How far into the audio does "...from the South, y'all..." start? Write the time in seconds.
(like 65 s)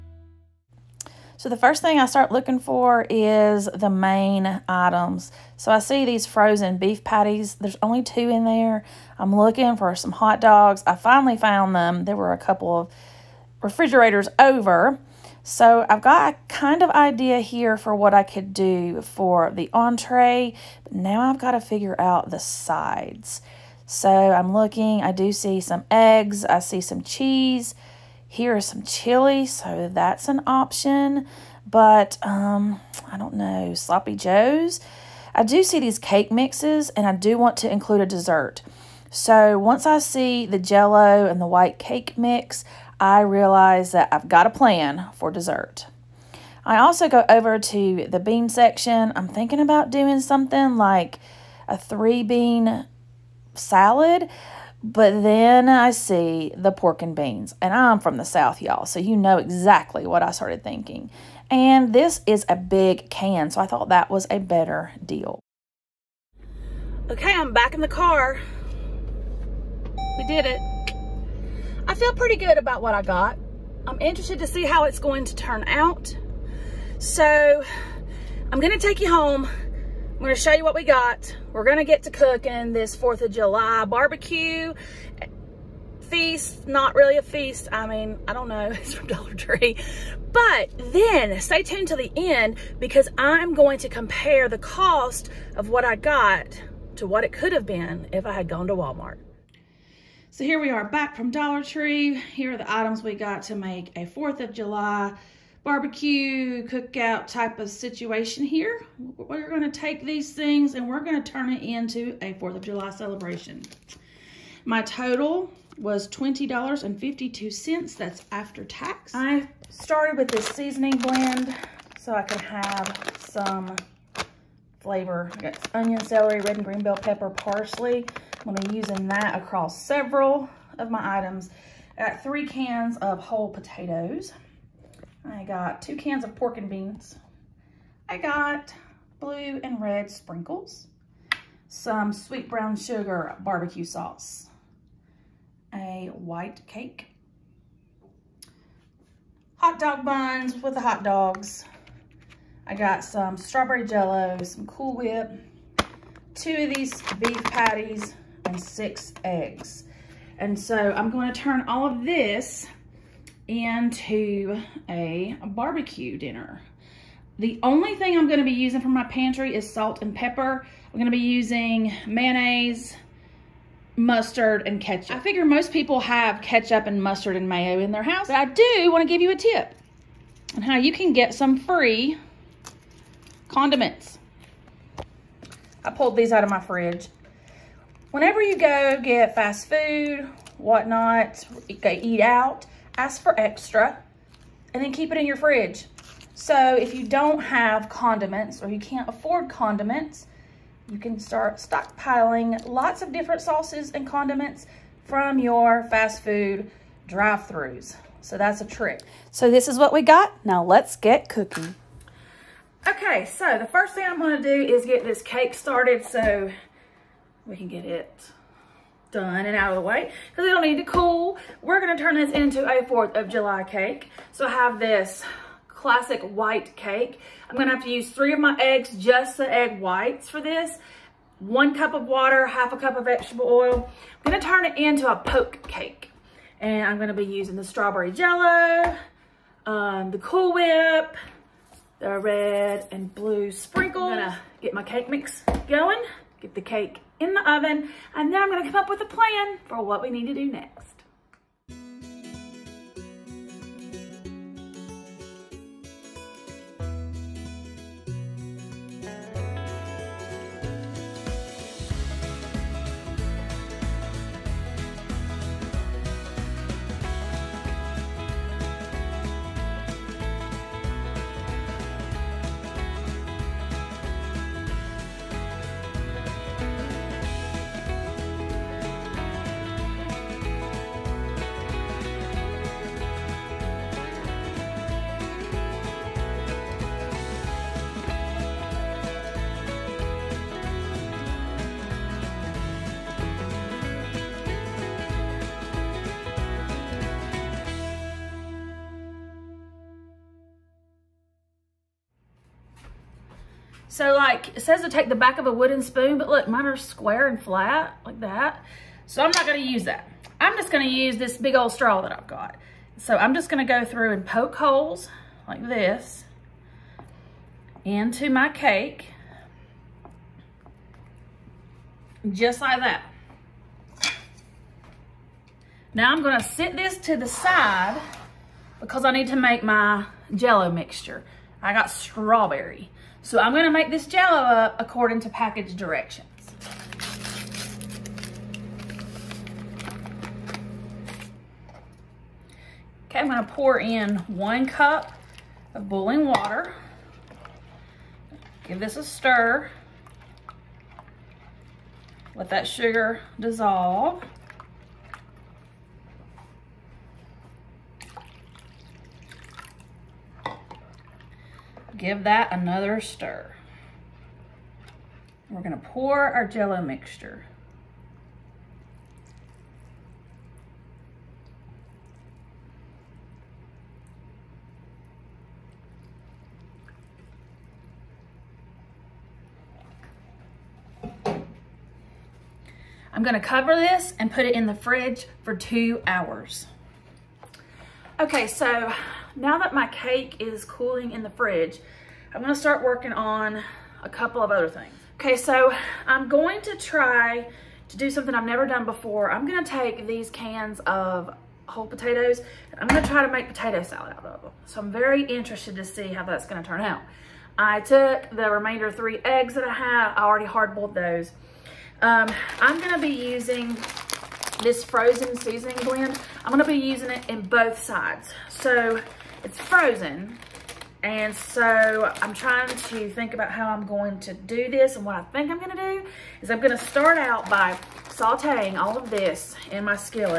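57 s.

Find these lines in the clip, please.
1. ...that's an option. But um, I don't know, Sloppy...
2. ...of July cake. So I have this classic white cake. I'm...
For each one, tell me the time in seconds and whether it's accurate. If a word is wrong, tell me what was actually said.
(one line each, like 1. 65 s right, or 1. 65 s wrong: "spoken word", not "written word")
1. 29 s right
2. 223 s right.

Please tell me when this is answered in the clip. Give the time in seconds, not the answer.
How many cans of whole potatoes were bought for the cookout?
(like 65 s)
132 s.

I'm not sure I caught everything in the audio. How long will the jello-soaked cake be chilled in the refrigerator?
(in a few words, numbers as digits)
2 hours.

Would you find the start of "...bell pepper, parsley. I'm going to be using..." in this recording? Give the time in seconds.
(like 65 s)
126 s.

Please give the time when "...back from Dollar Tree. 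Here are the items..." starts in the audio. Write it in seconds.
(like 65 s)
100 s.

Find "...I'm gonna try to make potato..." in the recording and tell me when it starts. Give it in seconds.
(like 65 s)
402 s.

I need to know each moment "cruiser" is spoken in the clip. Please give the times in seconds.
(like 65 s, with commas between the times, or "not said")
not said.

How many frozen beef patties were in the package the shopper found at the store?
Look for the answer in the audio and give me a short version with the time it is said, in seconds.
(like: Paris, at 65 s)
2, at 7 s.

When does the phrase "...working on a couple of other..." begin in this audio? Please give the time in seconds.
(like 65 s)
392 s.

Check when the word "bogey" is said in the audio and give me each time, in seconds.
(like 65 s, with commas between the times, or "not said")
not said.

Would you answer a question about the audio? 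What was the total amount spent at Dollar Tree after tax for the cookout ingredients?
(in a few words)
$20.52.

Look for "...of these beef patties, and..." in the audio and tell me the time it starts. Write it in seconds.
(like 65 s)
156 s.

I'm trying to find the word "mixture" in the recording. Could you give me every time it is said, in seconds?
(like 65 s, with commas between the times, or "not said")
330 s, 366 s.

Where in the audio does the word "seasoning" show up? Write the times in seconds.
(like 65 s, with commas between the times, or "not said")
120 s, 415 s.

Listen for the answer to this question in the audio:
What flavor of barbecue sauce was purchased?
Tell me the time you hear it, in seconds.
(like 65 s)
142 s.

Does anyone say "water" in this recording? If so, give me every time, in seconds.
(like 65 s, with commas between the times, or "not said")
232 s, 346 s.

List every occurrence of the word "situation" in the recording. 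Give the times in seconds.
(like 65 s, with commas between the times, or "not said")
107 s.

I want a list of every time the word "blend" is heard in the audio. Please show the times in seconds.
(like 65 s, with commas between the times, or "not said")
120 s, 415 s.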